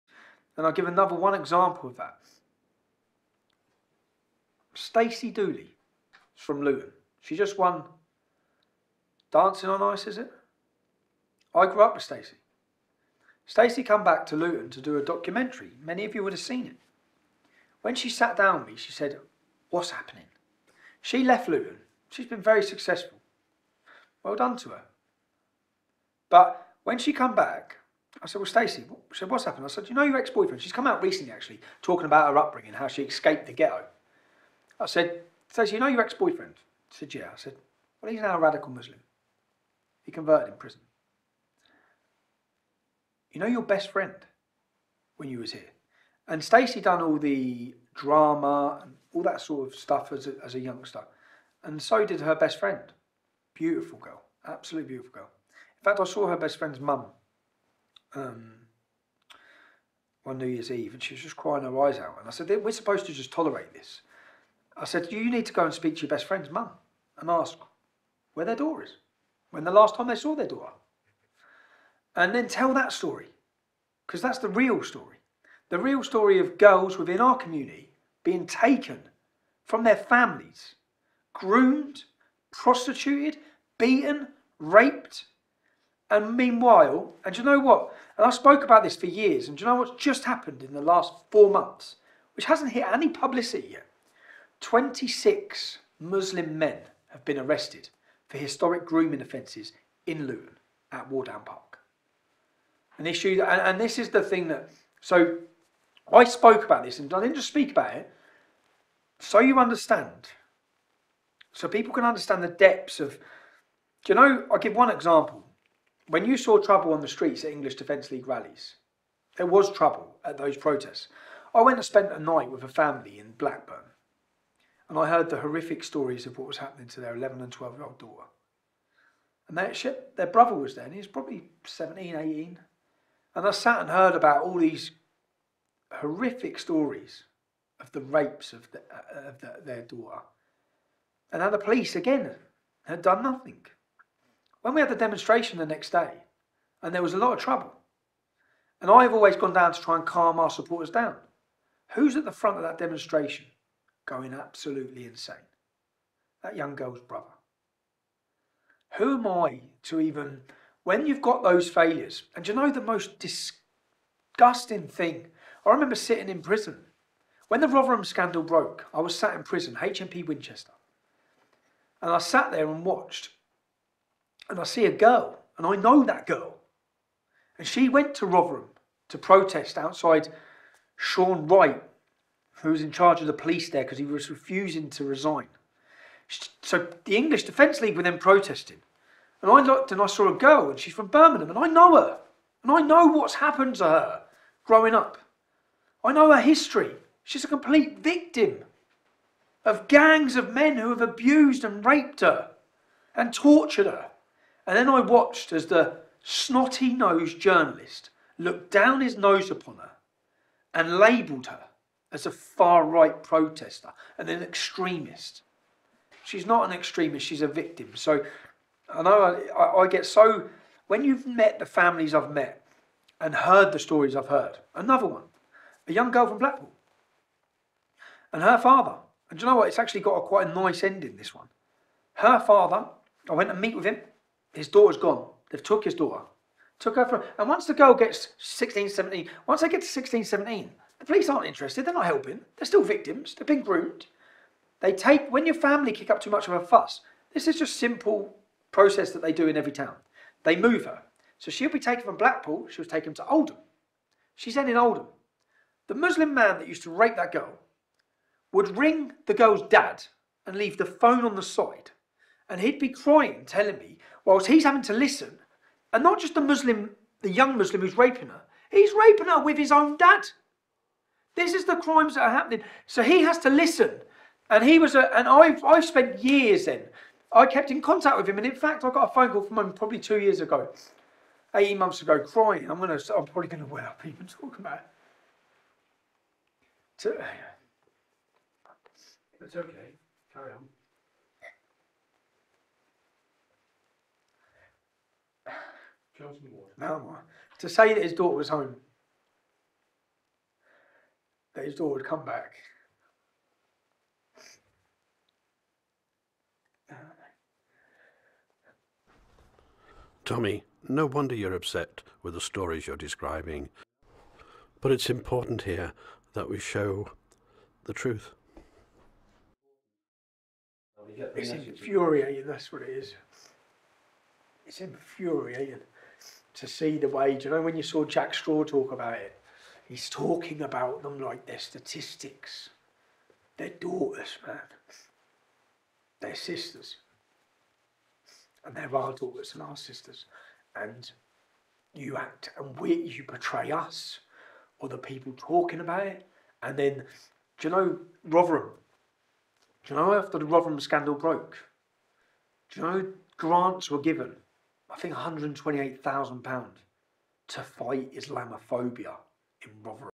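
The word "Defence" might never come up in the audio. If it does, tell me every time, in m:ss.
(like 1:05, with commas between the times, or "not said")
1:57, 3:07.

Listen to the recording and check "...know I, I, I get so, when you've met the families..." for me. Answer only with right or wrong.
right.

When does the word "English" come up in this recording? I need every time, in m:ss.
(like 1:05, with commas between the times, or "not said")
1:57, 3:07.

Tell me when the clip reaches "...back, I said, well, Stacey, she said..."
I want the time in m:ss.
0:27.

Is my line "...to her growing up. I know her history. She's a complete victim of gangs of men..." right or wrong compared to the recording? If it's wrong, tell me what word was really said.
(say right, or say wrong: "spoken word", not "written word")
right.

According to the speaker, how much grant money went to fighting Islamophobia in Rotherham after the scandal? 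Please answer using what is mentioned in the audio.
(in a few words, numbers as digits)
£128,000.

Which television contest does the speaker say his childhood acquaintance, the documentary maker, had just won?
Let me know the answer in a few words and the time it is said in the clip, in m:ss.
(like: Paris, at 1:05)
Dancing on Ice, at 0:09.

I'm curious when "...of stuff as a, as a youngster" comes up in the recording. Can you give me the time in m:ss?
0:49.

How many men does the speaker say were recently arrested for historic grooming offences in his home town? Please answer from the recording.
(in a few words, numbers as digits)
26.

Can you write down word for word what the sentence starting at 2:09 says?
And their, ship, their brother was there and he was probably 17, 18.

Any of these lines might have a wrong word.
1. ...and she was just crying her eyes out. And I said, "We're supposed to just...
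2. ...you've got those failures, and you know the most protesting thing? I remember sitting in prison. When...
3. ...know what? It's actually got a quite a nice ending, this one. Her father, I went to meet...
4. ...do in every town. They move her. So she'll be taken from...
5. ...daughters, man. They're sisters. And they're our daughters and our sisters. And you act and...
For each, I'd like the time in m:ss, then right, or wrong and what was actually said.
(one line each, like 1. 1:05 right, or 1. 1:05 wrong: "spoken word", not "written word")
1. 1:00 right
2. 2:41 wrong: "disgusting", not "protesting"
3. 3:49 right
4. 4:09 right
5. 5:33 right.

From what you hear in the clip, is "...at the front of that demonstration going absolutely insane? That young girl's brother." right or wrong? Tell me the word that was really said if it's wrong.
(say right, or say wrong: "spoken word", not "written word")
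right.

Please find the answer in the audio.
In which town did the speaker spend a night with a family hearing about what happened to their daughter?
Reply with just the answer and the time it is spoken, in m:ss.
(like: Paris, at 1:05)
Blackburn, at 2:03.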